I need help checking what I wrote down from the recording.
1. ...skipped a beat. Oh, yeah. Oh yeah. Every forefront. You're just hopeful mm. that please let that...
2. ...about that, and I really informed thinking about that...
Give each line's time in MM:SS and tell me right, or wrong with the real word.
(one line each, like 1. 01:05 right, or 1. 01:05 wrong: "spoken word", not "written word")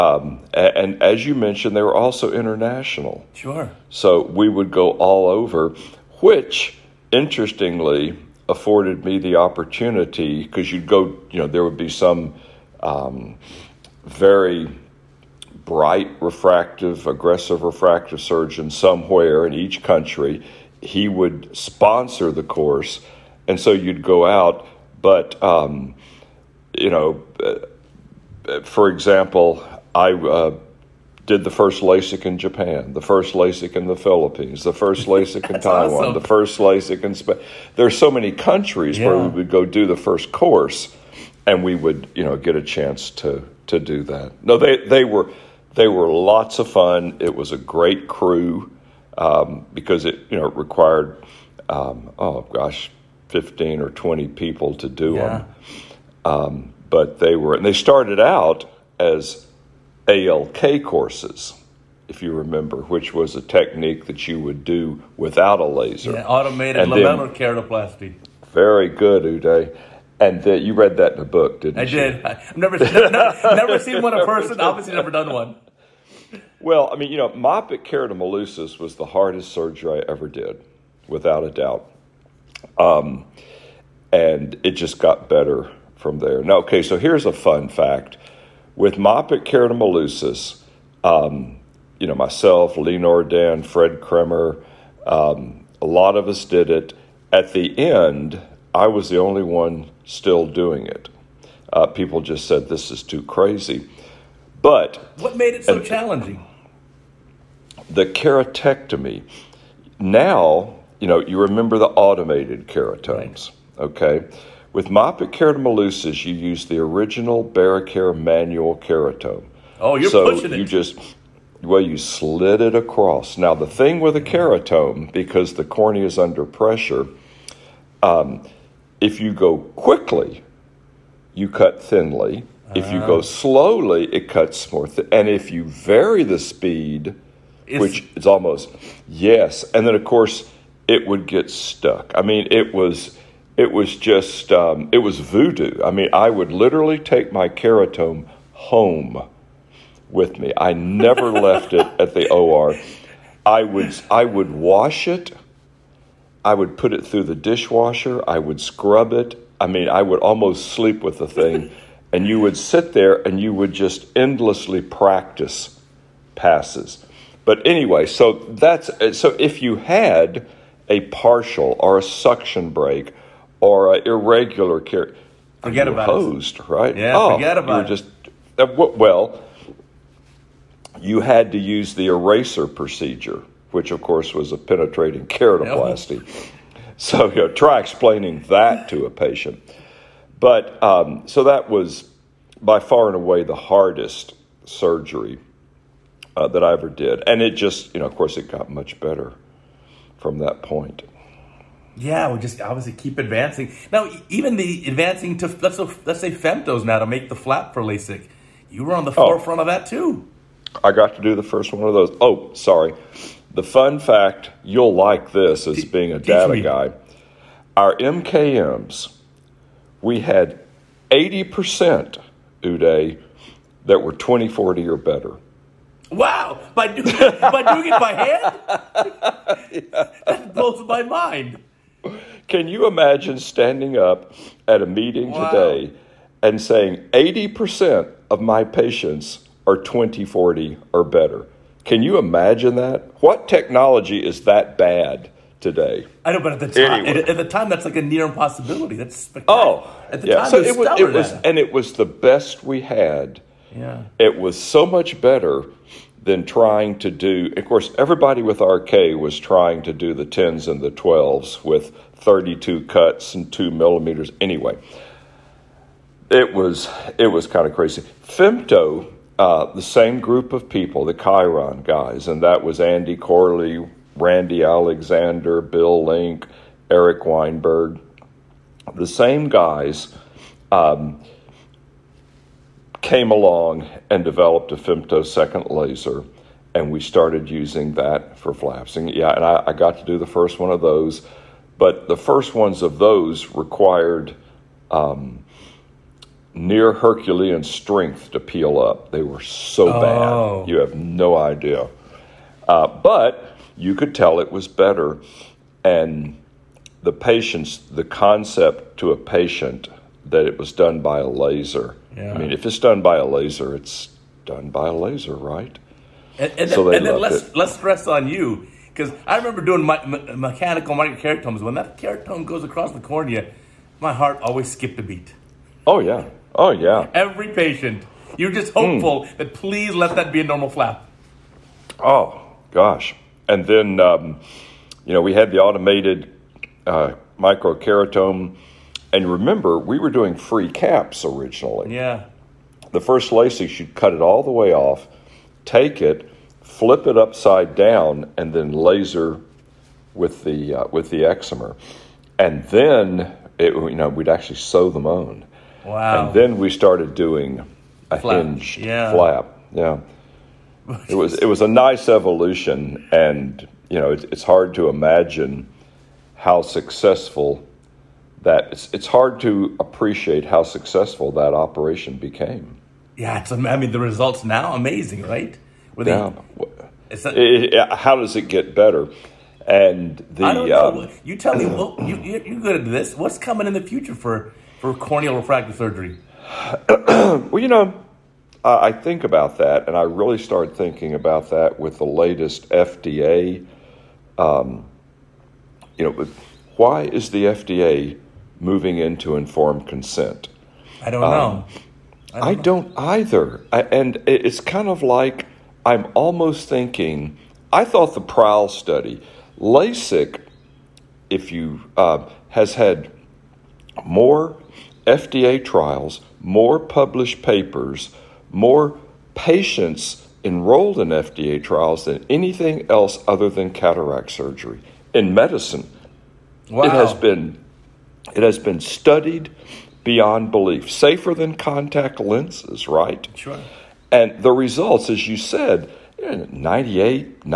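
1. 05:24 wrong: "patient", not "forefront"
2. 06:29 wrong: "started", not "informed".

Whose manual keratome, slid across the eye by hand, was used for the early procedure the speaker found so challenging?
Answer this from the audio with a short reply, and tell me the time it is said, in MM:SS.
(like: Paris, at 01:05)
Barraquer, at 01:57.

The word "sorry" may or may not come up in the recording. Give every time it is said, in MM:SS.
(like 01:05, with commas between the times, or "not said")
03:32.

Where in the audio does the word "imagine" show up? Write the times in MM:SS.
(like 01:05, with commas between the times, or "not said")
03:52, 04:02, 06:04.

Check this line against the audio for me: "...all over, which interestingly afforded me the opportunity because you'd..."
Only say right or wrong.
right.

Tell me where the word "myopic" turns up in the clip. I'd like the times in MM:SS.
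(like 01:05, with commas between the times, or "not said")
01:17, 01:28, 01:54.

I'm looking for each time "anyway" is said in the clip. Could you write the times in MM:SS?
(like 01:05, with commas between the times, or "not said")
02:47, 04:07, 04:24.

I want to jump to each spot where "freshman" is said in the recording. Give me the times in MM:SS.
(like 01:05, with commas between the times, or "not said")
not said.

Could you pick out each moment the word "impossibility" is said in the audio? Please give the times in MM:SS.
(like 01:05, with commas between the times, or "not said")
04:08.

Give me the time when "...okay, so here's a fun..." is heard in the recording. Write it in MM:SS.
01:26.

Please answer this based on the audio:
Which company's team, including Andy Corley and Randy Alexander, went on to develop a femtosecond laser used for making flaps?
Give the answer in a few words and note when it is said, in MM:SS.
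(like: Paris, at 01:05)
Chiron, at 04:31.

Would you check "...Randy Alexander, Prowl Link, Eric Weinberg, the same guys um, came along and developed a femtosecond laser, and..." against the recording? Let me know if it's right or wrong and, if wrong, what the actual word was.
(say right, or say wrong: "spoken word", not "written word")
wrong: "Bill", not "Prowl".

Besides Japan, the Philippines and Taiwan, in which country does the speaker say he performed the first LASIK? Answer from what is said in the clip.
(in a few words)
Spain.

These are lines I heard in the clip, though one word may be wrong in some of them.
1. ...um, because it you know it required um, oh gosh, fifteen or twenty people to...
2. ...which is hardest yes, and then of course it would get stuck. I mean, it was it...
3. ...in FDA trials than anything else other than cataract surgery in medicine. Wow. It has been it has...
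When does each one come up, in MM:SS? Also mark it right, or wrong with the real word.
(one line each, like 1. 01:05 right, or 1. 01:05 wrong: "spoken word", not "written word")
1. 00:49 right
2. 02:17 wrong: "almost", not "hardest"
3. 07:00 right.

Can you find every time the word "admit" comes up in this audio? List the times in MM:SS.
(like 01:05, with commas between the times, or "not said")
not said.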